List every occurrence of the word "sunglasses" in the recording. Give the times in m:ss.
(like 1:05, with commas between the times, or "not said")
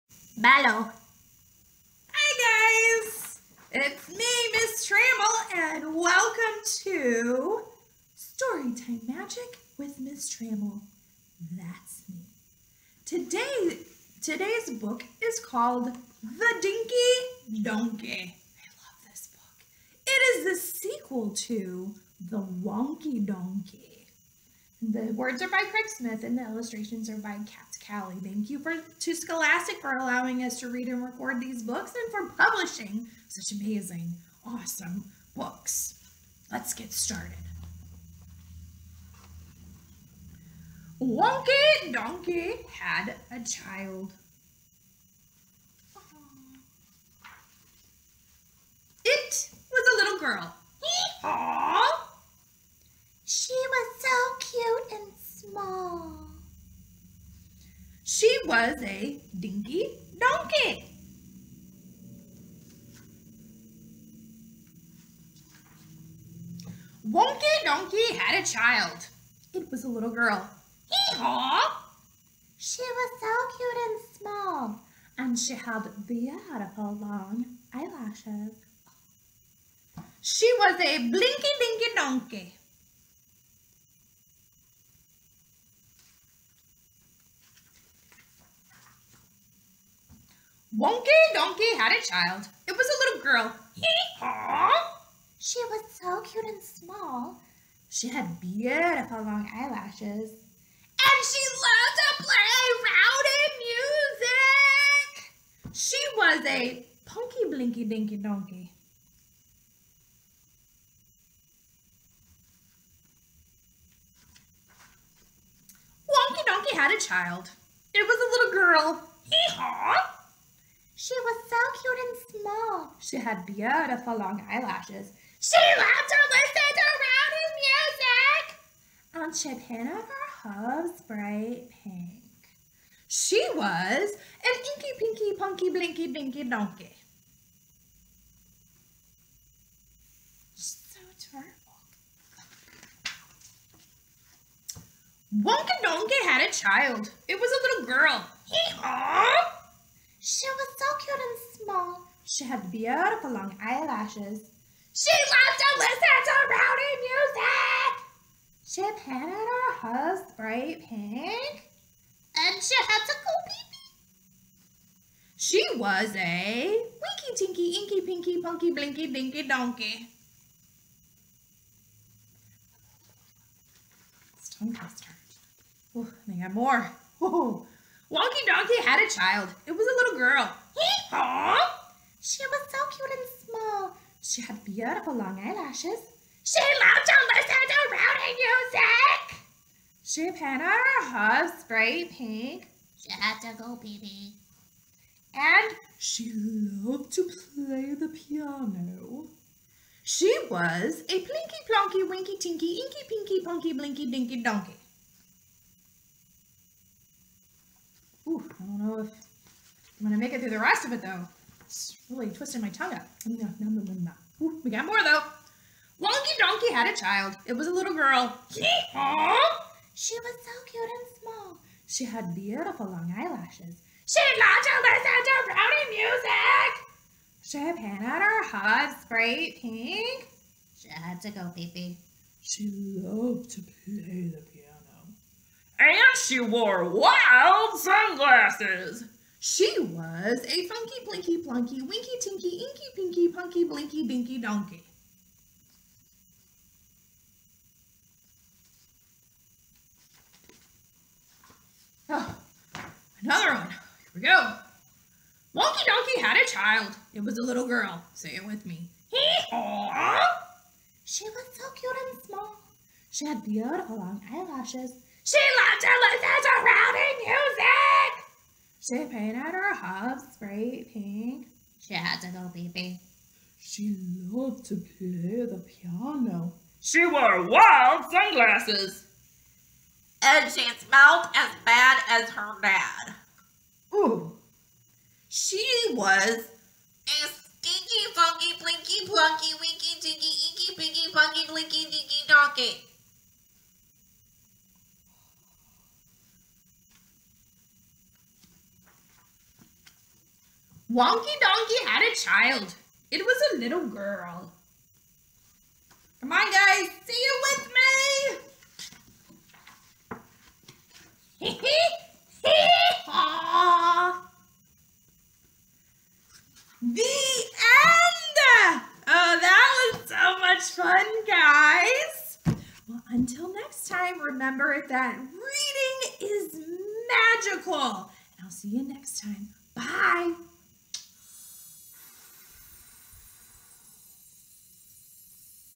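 3:57, 4:38.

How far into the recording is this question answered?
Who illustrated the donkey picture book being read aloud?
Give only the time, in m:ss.
0:27.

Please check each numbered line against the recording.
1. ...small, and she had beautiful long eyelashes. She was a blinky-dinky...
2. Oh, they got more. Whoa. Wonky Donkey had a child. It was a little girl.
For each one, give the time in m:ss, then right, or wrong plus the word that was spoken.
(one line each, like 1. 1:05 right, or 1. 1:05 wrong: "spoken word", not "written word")
1. 1:14 right
2. 2:55 right.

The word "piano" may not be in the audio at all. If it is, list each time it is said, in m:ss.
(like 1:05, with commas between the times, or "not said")
3:18, 3:54, 4:35.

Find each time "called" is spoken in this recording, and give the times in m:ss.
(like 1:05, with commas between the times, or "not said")
0:15.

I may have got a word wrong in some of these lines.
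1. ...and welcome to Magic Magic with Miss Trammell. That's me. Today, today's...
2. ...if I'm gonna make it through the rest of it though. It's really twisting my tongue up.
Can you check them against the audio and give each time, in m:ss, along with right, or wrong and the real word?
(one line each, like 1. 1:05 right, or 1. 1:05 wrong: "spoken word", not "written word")
1. 0:05 wrong: "Storytime", not "Magic"
2. 3:29 right.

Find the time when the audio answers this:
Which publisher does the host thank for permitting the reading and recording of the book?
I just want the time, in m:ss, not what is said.
0:29.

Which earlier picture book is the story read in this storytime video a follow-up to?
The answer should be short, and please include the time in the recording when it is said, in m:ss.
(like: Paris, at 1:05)
The Wonky Donkey, at 0:22.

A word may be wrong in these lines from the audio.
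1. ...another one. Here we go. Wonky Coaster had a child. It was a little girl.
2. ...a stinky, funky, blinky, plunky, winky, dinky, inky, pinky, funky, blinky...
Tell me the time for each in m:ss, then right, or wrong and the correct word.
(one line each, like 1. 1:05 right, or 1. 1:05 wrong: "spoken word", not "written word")
1. 4:13 wrong: "Donkey", not "Coaster"
2. 4:46 right.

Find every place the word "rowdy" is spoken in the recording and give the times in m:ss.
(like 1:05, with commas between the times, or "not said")
1:42, 2:07, 2:36, 3:07, 3:45, 4:26.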